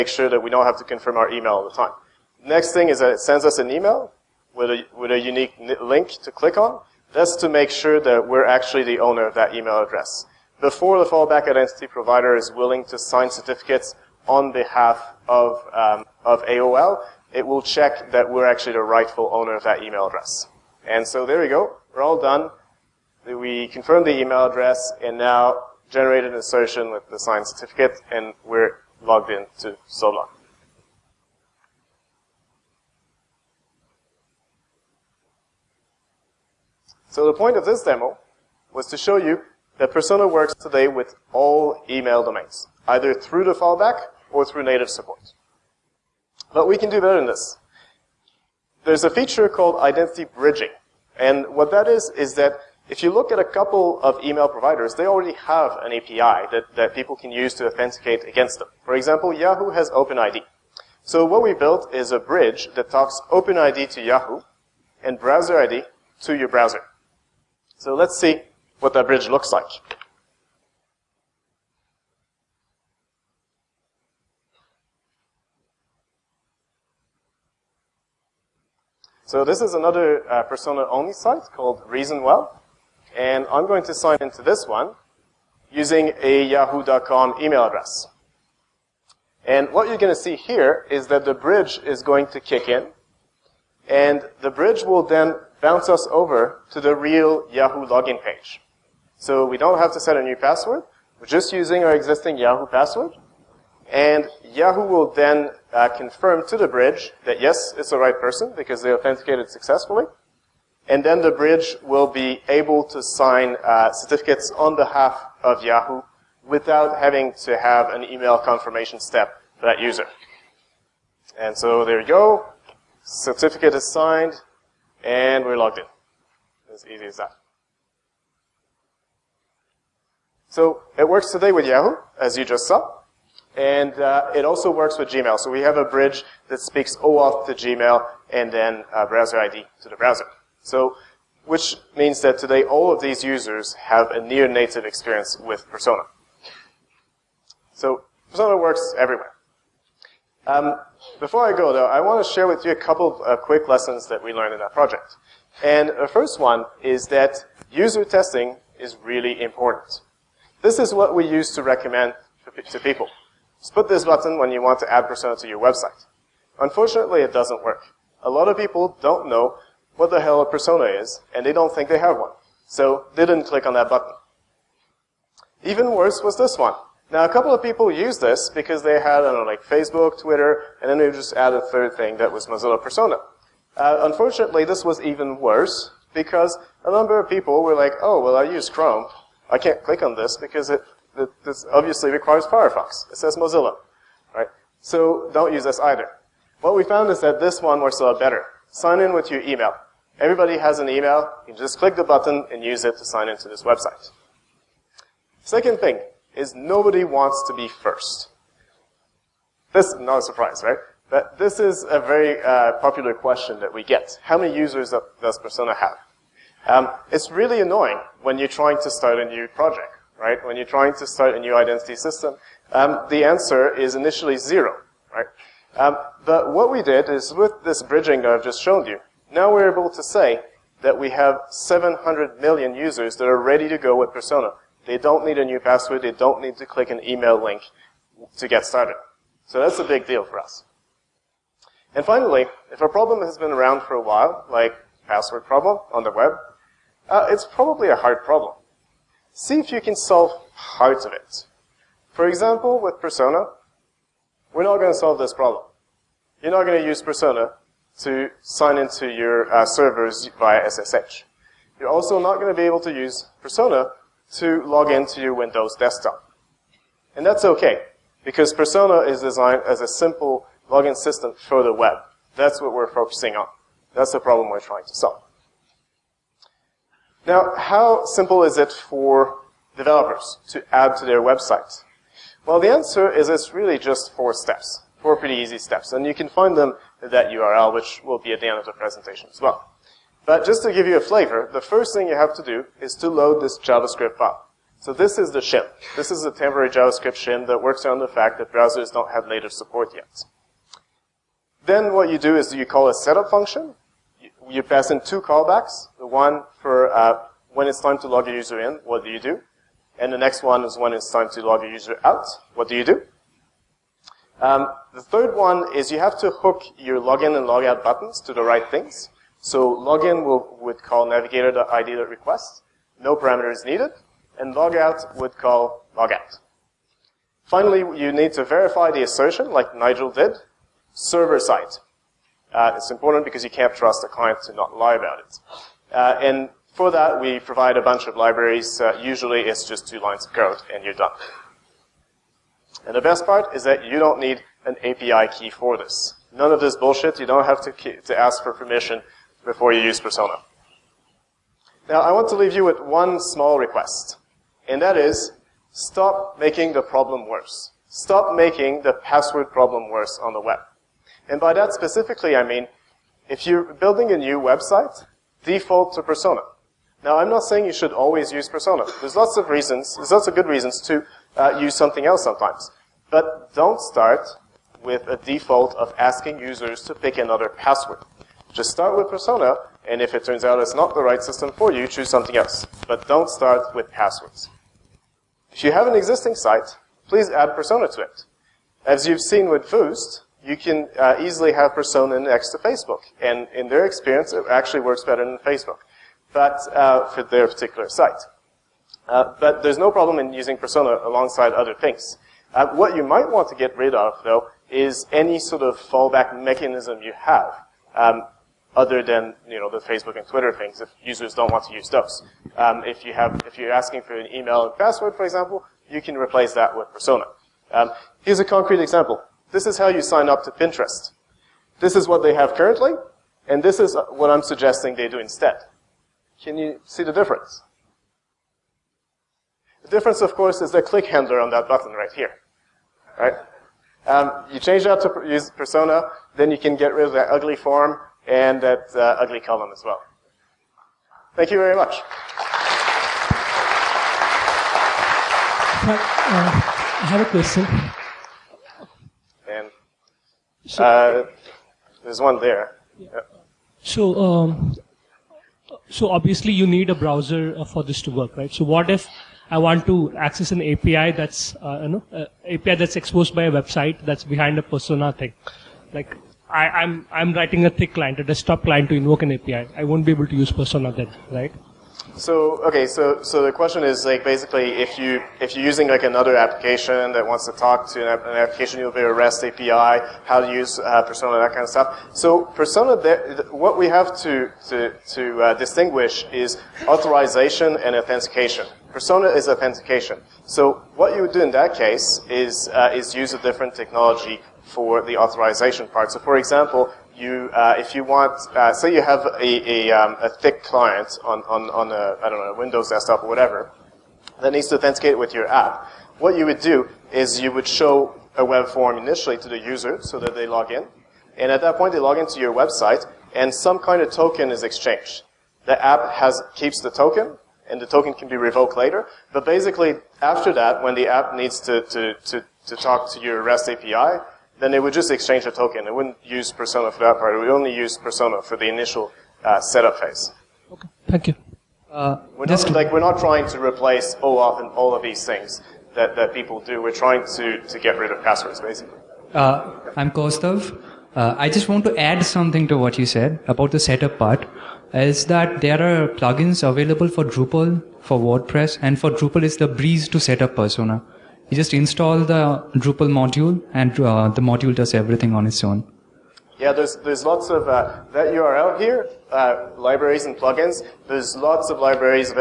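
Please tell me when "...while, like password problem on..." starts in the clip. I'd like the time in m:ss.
4:04.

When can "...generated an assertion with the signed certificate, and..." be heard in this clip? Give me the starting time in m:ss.
0:25.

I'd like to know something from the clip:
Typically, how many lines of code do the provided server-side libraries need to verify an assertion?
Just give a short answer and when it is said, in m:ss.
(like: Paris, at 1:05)
2, at 5:39.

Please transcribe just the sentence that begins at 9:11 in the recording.
You just install the Drupal module, and uh, the module does everything on its own.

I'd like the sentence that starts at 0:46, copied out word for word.
But we can do better than this.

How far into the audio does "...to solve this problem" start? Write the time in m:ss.
4:14.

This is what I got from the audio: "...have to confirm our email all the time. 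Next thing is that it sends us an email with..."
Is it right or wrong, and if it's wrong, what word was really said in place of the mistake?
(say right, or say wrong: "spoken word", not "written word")
right.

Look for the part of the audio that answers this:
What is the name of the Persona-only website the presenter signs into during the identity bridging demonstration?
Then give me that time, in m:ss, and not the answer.
1:21.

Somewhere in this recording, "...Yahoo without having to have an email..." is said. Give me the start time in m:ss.
1:55.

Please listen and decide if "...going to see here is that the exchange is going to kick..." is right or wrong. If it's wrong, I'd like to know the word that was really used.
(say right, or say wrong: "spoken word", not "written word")
wrong: "bridge", not "exchange".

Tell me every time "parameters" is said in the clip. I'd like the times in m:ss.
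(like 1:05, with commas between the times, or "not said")
5:23.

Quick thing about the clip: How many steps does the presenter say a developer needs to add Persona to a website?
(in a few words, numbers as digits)
4.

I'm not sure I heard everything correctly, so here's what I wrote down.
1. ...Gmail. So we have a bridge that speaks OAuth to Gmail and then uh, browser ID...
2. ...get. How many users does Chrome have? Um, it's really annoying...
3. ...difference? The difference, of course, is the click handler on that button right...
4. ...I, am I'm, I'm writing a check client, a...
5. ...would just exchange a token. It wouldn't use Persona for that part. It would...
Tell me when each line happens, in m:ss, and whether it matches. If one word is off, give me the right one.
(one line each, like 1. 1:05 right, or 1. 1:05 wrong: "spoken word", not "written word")
1. 2:15 right
2. 3:33 wrong: "Persona", not "Chrome"
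3. 7:07 right
4. 7:46 wrong: "thick", not "check"
5. 8:44 right.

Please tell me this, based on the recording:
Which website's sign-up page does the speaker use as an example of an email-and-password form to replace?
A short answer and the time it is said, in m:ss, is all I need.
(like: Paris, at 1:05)
Pinterest, at 7:00.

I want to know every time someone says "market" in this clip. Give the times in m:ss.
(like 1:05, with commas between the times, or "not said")
not said.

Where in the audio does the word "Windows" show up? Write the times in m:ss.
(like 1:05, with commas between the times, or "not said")
4:25, 8:22.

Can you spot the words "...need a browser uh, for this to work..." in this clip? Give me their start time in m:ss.
7:36.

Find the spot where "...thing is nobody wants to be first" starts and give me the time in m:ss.
3:25.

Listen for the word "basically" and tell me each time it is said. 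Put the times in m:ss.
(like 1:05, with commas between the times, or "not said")
7:54, 8:39, 8:58.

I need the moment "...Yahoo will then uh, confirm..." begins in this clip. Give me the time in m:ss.
1:44.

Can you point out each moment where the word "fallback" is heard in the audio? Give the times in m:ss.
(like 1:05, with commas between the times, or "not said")
0:11, 0:43, 6:45.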